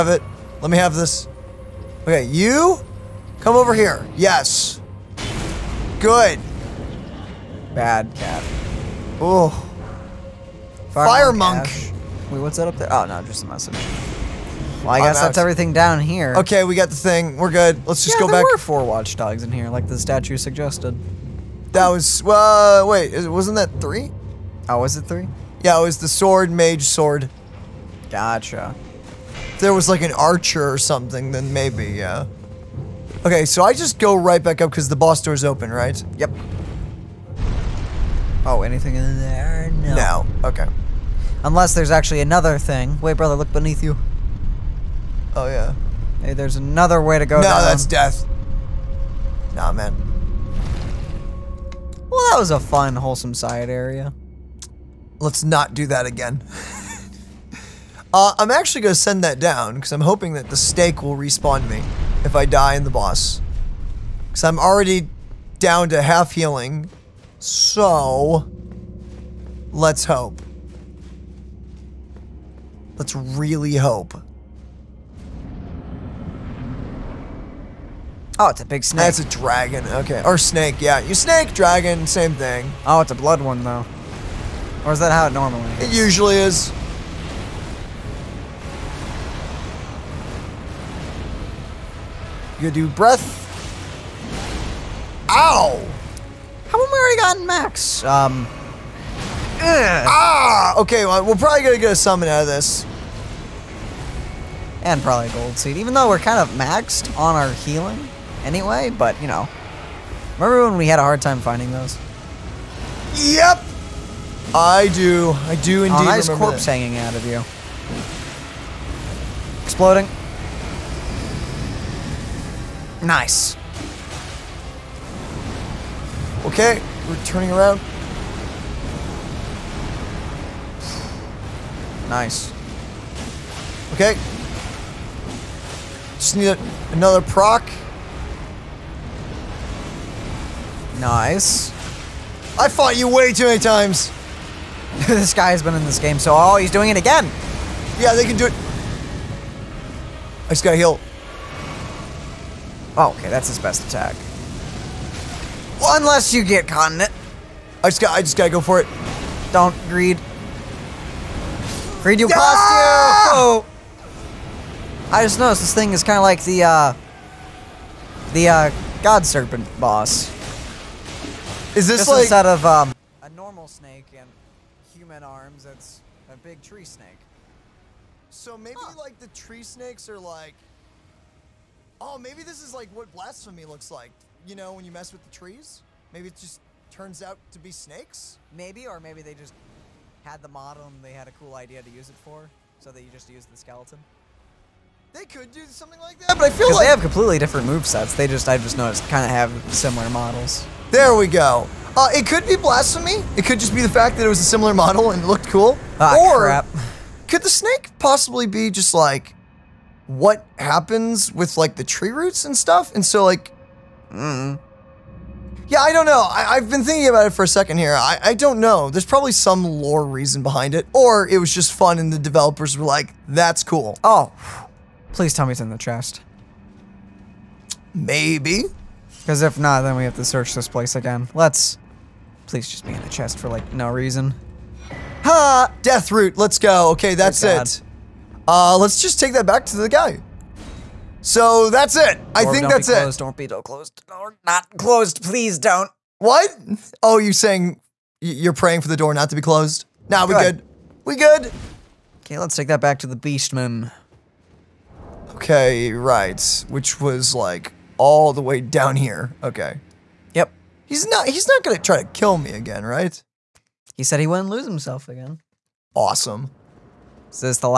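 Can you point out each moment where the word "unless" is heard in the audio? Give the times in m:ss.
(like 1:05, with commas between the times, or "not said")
0:41, 2:35.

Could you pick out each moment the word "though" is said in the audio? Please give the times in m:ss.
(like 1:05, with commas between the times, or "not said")
1:23, 1:45.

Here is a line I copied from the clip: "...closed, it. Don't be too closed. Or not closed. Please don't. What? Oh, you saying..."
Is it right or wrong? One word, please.
right.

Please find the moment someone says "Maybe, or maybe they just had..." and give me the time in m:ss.
3:08.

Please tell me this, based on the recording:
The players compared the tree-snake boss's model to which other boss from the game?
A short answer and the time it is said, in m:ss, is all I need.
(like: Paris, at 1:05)
God Serpent, at 2:49.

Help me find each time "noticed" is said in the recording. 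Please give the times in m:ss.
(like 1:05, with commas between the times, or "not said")
2:45, 3:18.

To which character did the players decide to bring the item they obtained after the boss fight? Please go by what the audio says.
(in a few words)
The Beastman.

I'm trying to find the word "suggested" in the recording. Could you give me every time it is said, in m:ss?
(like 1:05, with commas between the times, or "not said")
0:20.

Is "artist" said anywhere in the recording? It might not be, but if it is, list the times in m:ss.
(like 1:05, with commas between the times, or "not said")
not said.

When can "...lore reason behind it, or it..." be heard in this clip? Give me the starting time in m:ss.
3:39.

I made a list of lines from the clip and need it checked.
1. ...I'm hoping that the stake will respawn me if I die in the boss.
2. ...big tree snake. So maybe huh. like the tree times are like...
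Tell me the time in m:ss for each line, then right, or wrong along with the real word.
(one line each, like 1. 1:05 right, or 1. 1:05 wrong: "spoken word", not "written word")
1. 0:59 right
2. 2:56 wrong: "snakes", not "times".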